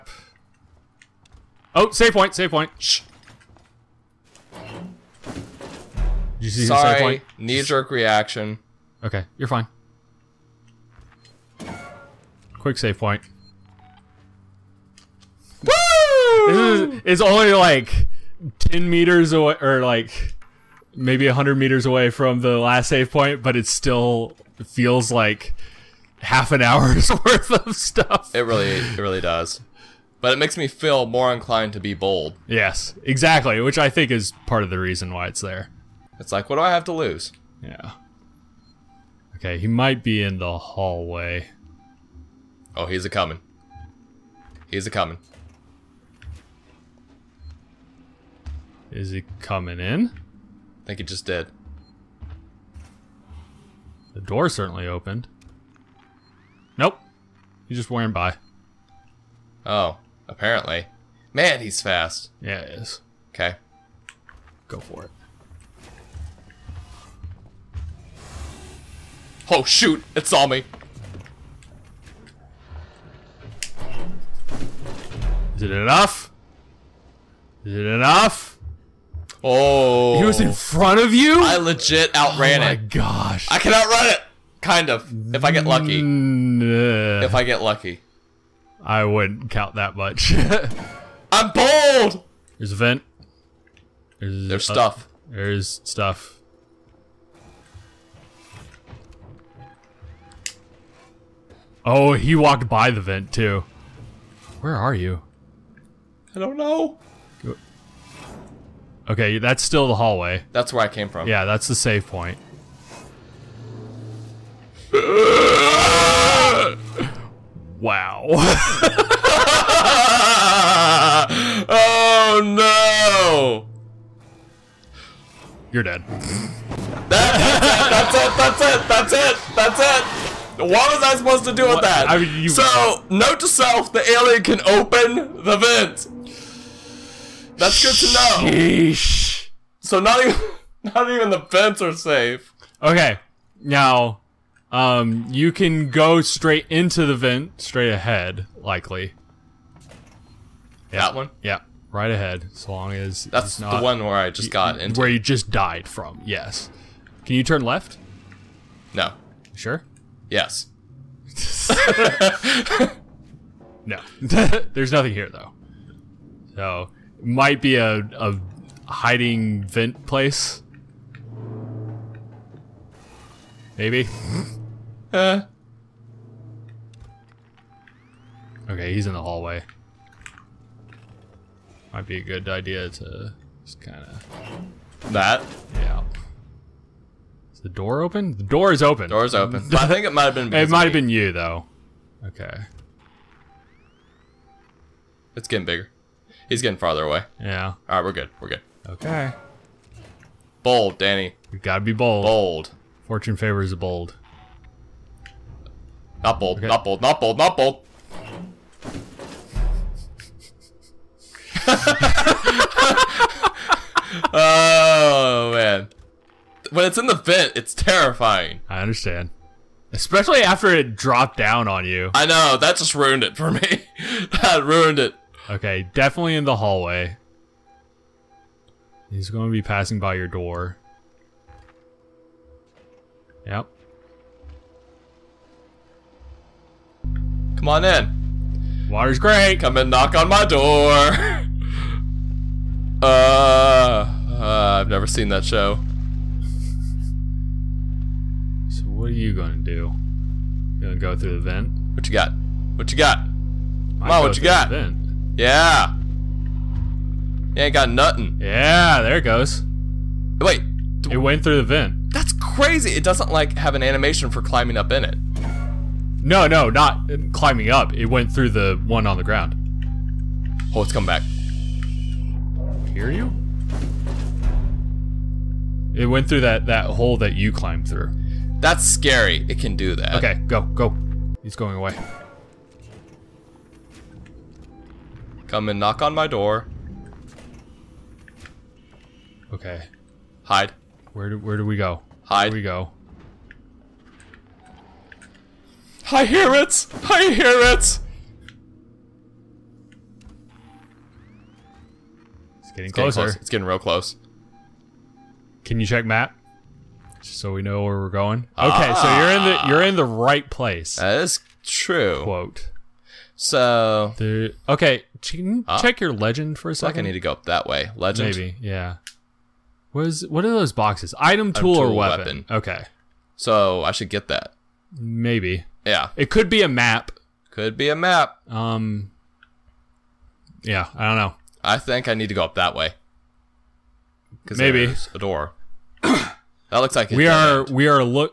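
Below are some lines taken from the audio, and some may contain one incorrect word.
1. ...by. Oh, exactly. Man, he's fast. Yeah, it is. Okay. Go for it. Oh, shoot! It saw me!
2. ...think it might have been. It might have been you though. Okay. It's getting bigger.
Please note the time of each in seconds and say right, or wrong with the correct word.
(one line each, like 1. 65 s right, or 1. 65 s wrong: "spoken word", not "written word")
1. 58 s wrong: "apparently", not "exactly"
2. 189 s right.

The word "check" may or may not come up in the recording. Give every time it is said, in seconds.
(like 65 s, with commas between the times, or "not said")
305 s, 315 s.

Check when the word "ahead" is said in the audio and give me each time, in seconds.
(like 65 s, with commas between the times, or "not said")
147 s, 152 s.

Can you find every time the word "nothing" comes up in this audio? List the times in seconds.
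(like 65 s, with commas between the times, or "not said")
164 s, 257 s.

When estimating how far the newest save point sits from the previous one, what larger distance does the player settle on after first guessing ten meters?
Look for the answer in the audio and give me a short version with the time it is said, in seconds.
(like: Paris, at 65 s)
100 meters, at 21 s.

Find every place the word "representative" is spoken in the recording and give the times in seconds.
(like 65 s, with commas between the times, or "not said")
not said.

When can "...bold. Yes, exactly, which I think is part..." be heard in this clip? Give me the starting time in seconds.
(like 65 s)
31 s.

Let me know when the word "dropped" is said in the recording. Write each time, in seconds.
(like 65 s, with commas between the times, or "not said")
220 s.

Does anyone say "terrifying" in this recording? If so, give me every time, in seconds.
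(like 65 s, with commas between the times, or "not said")
217 s.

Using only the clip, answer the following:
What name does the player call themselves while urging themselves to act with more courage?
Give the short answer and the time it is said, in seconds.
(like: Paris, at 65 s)
Danny, at 200 s.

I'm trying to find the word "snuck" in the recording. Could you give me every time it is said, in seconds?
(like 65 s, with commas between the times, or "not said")
not said.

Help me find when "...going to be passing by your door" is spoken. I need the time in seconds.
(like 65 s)
229 s.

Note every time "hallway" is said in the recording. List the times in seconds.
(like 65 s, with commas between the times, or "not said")
40 s, 109 s, 179 s, 226 s.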